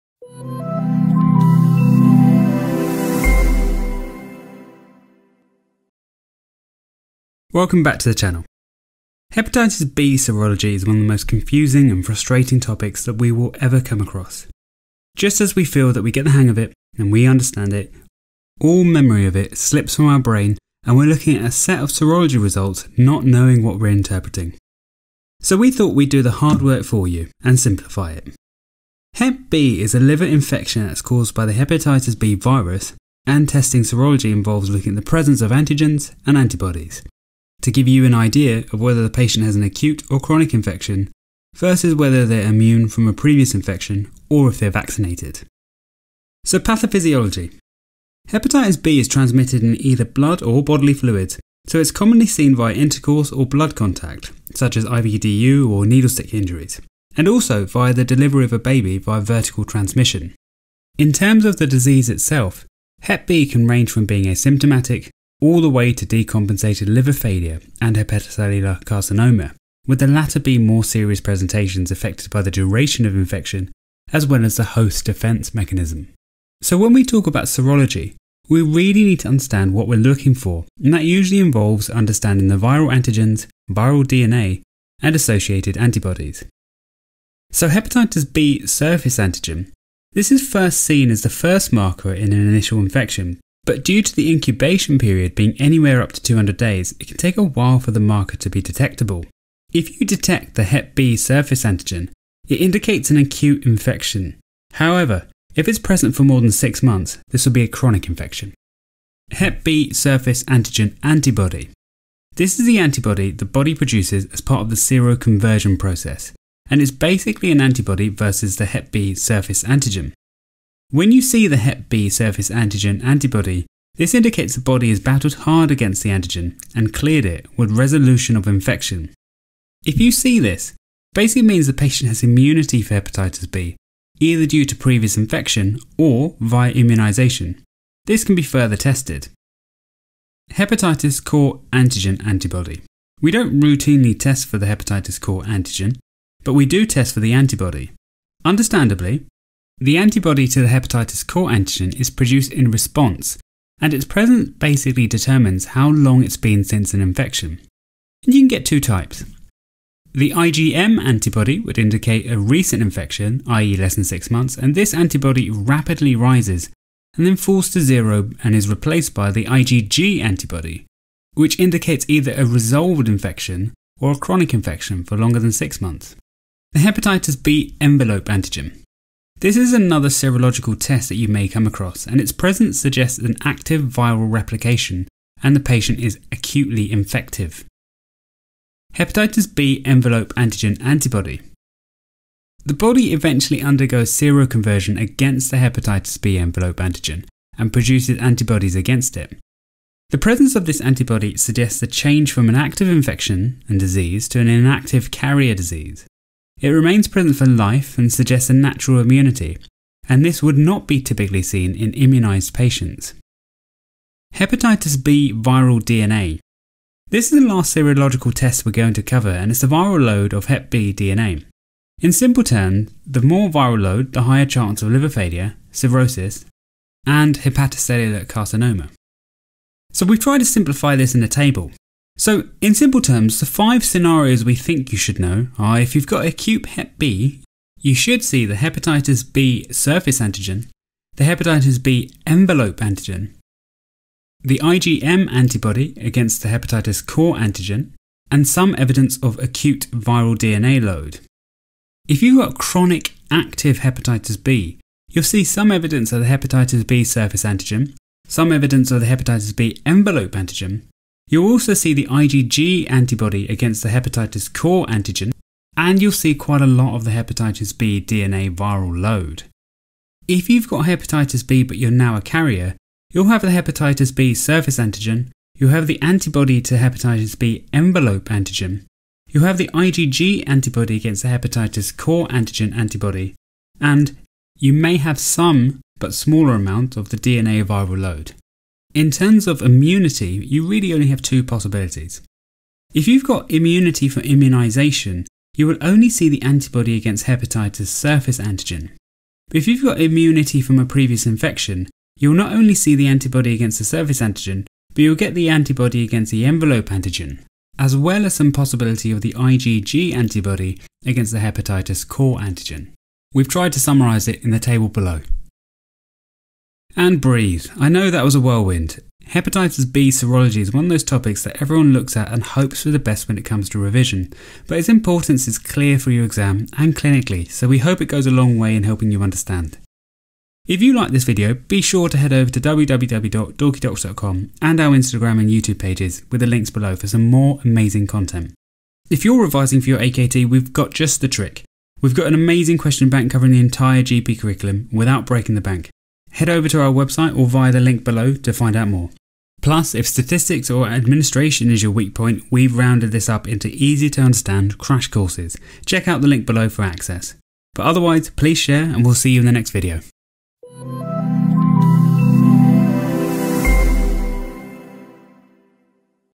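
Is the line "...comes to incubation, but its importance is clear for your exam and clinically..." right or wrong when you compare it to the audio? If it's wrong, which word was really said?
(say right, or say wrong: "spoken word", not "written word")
wrong: "revision", not "incubation".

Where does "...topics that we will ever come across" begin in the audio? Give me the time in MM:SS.
00:12.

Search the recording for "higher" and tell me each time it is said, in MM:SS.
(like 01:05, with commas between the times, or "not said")
03:44.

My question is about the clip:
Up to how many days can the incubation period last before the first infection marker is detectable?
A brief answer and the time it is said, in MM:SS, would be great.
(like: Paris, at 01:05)
200 days, at 01:36.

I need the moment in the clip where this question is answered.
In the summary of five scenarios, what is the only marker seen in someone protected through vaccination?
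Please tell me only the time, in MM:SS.
04:56.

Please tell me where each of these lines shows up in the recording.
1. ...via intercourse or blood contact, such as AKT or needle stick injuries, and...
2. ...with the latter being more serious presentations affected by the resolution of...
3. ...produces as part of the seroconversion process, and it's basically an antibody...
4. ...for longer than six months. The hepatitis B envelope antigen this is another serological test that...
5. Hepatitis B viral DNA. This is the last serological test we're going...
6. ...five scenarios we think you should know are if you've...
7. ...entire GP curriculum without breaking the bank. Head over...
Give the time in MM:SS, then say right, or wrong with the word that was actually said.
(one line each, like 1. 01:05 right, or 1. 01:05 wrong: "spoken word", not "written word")
1. 00:52 wrong: "IVDU", not "AKT"
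2. 01:09 wrong: "duration", not "resolution"
3. 01:53 right
4. 02:55 right
5. 03:34 right
6. 03:53 right
7. 05:43 right.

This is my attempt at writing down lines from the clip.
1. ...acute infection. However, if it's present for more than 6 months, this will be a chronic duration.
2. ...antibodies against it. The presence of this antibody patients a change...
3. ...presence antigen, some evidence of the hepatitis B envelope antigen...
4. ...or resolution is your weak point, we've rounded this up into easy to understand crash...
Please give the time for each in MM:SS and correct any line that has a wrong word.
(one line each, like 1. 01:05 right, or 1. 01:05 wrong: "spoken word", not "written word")
1. 01:43 wrong: "infection", not "duration"
2. 03:18 wrong: "suggests", not "patients"
3. 04:17 wrong: "surface", not "presence"
4. 05:50 wrong: "administration", not "resolution".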